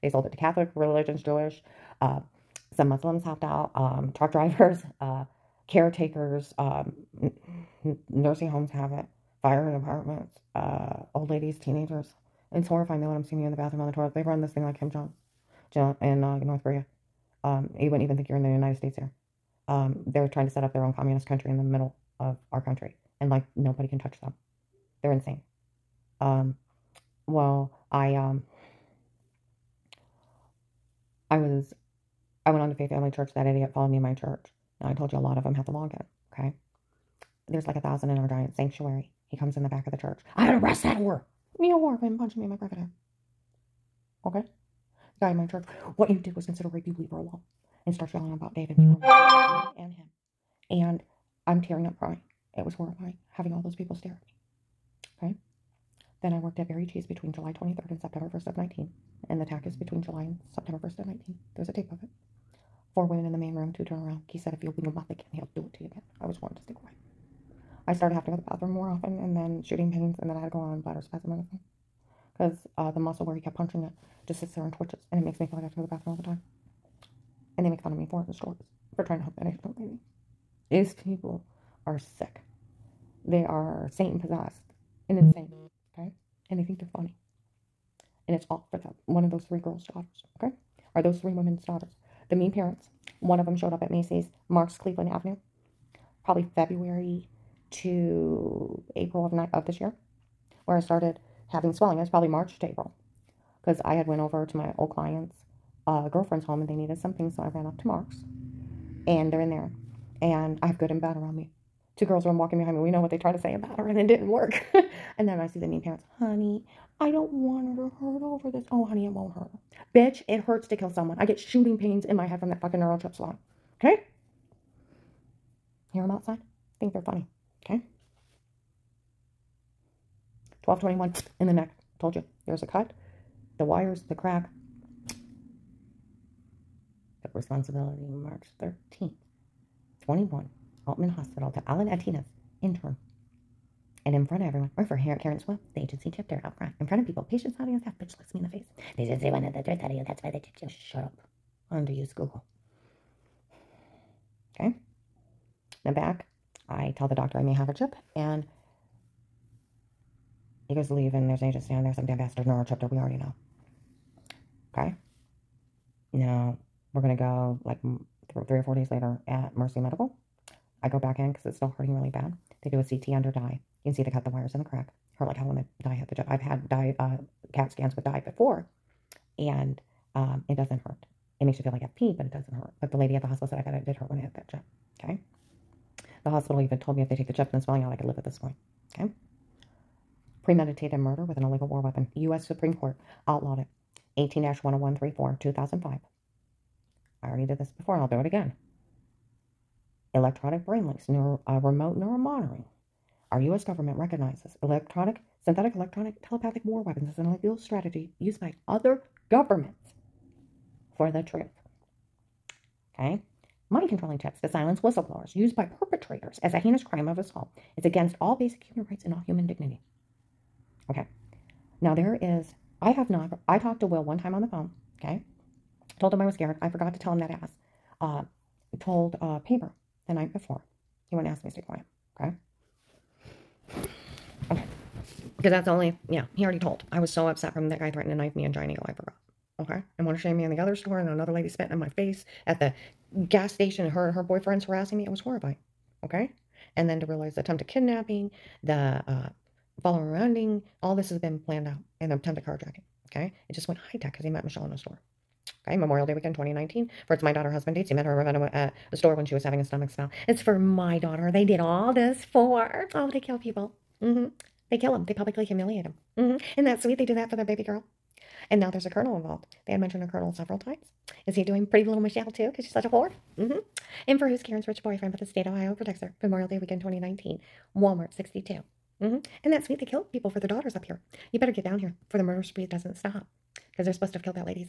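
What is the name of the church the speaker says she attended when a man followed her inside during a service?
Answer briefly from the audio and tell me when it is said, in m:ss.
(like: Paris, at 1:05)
Faith Family Church, at 0:32.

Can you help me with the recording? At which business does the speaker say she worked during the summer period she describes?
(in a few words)
Berry Cheese.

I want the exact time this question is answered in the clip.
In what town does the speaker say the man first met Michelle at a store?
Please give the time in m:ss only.
4:18.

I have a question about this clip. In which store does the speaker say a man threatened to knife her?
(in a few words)
Giant Eagle.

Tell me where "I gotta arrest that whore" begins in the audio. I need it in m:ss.
0:40.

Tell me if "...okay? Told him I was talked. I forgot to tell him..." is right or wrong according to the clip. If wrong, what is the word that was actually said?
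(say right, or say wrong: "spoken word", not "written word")
wrong: "scared", not "talked".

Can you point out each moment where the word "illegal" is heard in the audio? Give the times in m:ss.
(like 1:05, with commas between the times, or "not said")
3:11, 3:27.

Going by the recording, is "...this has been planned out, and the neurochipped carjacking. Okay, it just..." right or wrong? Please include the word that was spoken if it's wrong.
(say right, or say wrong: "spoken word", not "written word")
wrong: "attempted", not "neurochipped".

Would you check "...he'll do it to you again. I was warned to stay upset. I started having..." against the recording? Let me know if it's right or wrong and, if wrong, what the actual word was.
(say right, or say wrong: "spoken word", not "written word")
wrong: "quiet", not "upset".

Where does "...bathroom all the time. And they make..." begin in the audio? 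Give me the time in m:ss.
1:15.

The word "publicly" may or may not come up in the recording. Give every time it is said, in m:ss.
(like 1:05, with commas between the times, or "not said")
4:25.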